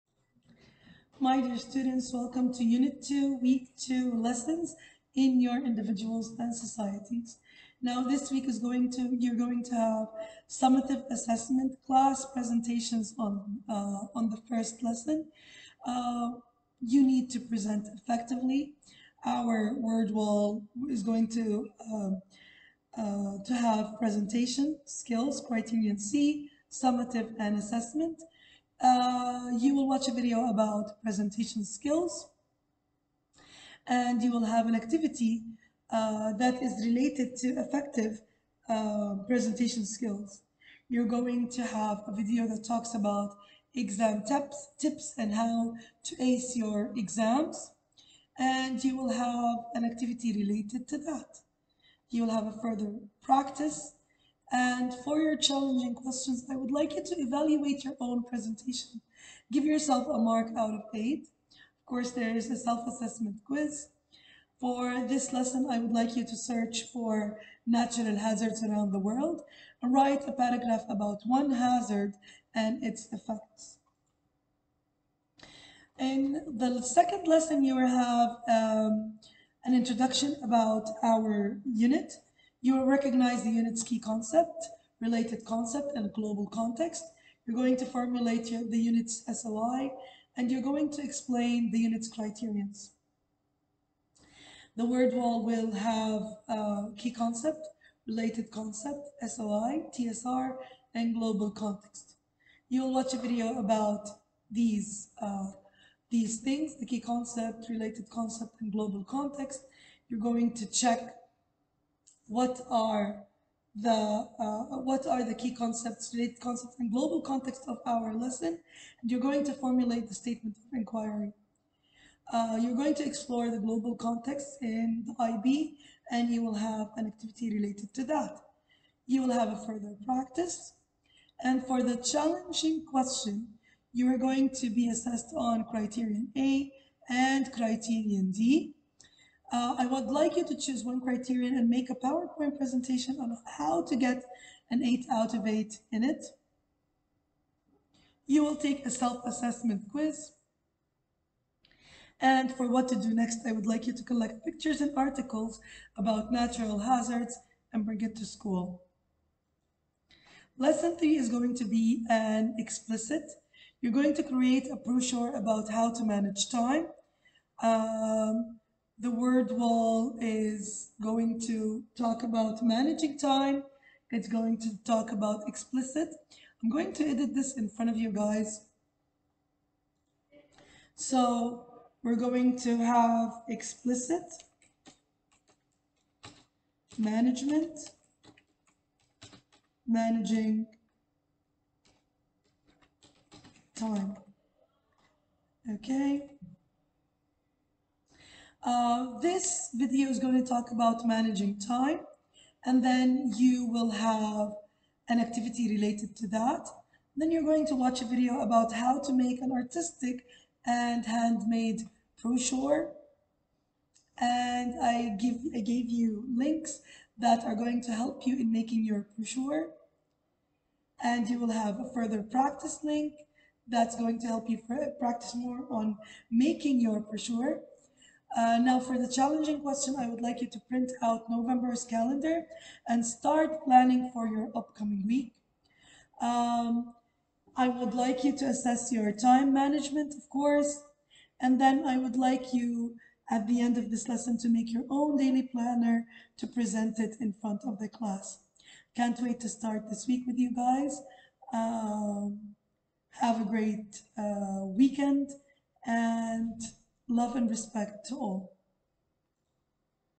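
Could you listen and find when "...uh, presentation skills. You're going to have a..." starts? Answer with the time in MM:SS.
00:38.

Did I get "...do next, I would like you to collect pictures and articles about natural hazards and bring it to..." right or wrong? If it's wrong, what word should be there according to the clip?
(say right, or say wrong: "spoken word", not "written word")
right.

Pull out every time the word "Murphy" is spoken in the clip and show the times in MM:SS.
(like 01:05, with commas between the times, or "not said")
not said.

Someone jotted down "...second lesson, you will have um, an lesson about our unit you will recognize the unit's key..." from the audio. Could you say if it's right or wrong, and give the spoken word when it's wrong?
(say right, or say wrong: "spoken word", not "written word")
wrong: "introduction", not "lesson".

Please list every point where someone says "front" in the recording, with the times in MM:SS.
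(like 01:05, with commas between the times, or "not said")
02:57, 04:07.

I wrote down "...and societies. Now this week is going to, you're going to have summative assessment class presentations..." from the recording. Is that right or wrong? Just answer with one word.
right.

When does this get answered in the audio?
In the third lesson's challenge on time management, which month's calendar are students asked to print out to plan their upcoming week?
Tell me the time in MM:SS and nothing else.
03:51.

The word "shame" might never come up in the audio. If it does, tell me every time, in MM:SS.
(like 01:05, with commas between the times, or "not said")
not said.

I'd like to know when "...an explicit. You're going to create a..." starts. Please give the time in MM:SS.
02:42.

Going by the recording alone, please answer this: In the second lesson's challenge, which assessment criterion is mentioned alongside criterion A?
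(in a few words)
criterion D.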